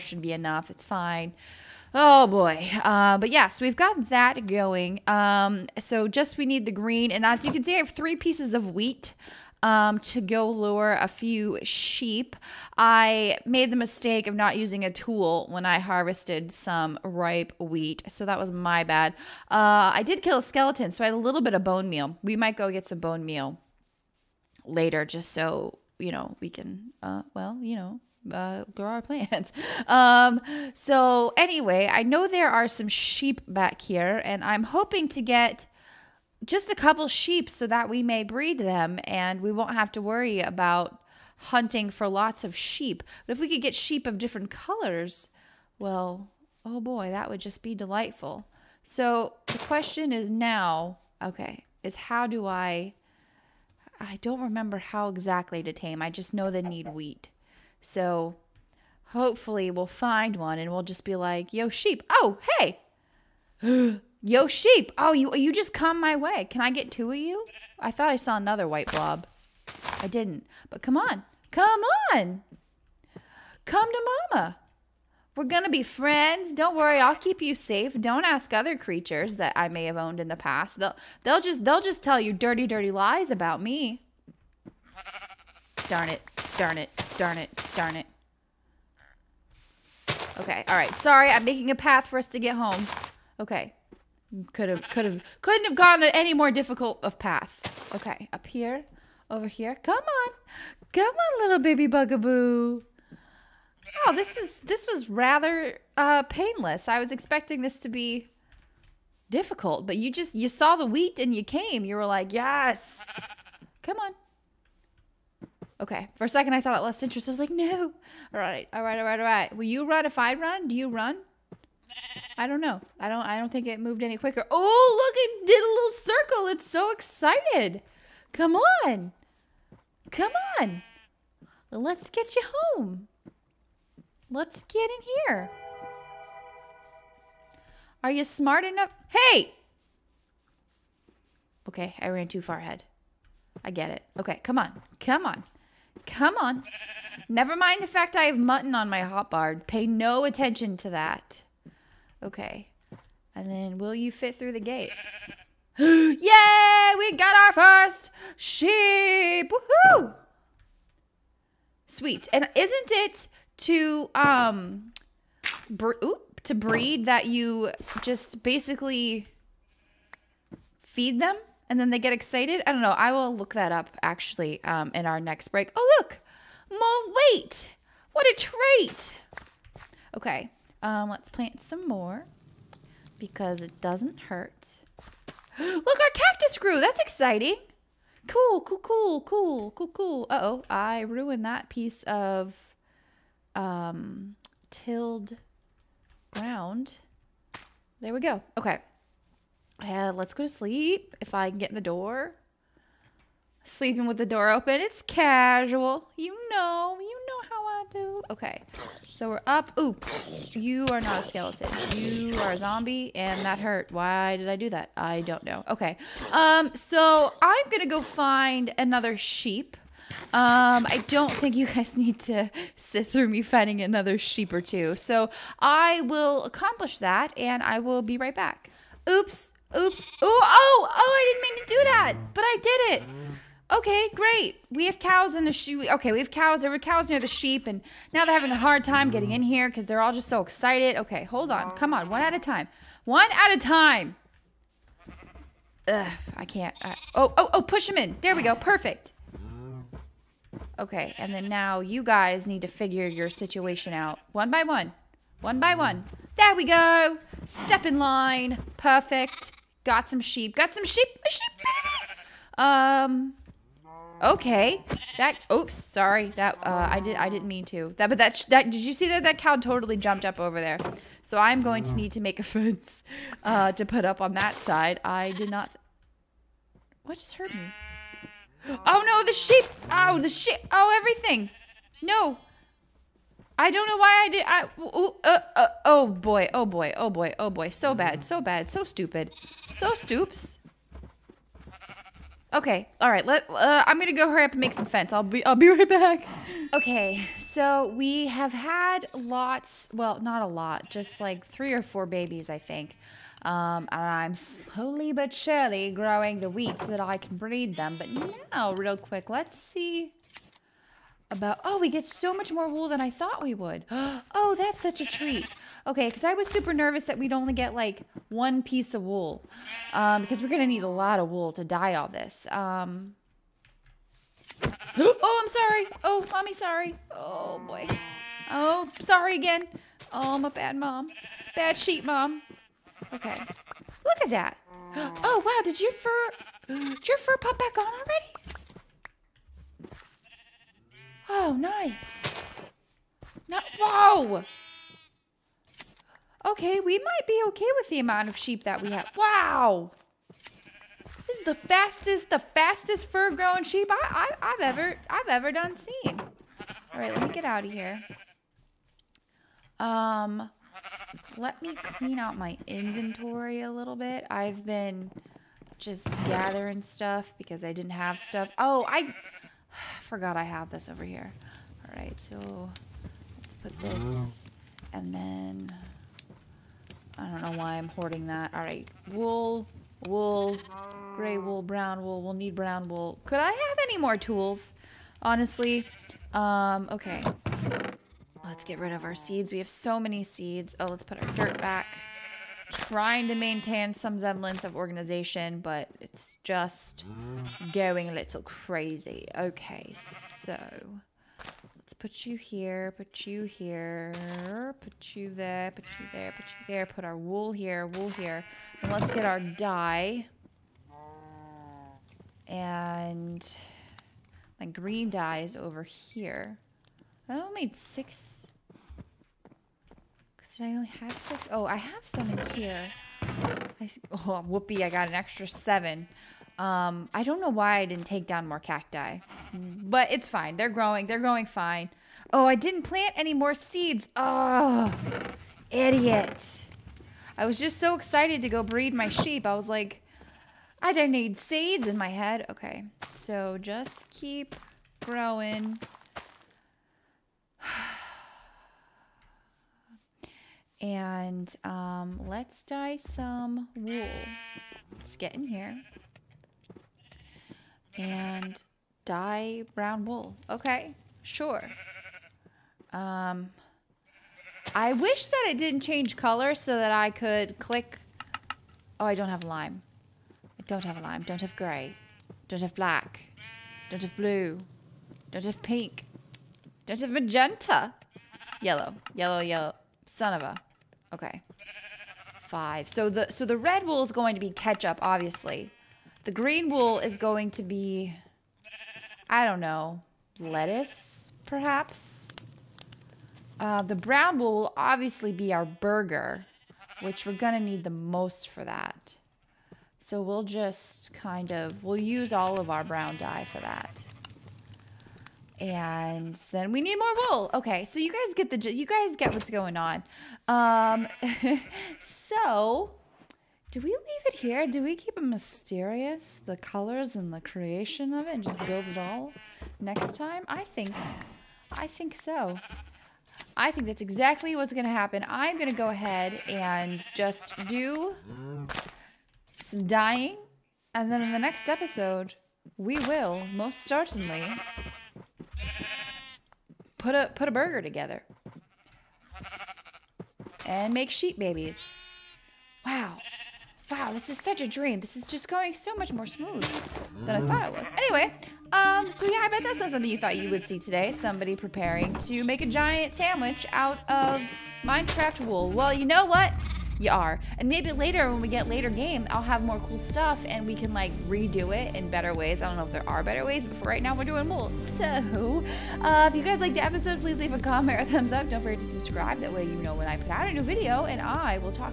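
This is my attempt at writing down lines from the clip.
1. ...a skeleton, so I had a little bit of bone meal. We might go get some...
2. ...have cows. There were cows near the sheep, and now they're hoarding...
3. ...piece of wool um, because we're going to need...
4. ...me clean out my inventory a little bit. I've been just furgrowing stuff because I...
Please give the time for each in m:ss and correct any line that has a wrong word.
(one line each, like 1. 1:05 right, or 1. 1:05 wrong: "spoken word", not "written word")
1. 0:20 right
2. 3:56 wrong: "having", not "hoarding"
3. 5:18 right
4. 6:01 wrong: "gathering", not "furgrowing".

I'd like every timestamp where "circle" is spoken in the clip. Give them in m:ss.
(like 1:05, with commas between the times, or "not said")
2:05.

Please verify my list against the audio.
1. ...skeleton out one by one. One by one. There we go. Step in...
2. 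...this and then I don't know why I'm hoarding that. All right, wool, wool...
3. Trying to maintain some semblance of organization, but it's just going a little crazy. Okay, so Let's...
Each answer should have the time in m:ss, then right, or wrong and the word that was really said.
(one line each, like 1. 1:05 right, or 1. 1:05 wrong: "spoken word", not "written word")
1. 4:13 wrong: "situation", not "skeleton"
2. 6:13 right
3. 6:32 right.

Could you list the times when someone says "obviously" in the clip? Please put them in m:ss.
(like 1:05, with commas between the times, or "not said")
8:05, 8:14.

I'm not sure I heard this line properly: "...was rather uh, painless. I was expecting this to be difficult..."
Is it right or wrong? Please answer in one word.
right.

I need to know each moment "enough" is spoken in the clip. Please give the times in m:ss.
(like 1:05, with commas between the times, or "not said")
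0:00, 2:18.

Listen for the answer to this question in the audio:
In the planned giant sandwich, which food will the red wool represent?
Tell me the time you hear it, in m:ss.
8:04.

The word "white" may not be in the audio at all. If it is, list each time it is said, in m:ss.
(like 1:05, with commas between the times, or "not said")
1:08.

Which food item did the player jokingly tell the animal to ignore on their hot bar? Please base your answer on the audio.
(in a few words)
mutton.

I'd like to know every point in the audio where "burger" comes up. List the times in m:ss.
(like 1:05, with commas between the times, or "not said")
8:15, 8:57.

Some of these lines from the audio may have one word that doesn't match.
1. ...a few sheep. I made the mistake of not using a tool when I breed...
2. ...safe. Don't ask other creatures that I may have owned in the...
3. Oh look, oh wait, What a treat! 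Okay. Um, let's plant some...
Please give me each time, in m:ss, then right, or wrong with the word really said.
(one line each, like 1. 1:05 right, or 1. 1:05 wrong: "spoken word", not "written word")
1. 0:10 wrong: "harvested", not "breed"
2. 1:17 right
3. 2:55 right.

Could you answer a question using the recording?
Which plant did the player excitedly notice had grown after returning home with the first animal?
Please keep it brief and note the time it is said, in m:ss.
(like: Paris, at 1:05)
cactus, at 3:05.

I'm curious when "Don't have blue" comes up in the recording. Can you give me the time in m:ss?
7:53.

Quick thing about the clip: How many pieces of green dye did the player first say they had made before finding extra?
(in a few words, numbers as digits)
6.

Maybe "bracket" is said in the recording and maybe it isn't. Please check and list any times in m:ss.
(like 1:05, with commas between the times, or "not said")
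not said.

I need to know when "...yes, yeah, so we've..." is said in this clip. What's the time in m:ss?
0:03.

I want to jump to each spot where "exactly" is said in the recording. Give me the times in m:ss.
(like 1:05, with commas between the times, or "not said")
0:55, 8:44.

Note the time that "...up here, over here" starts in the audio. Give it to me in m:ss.
1:38.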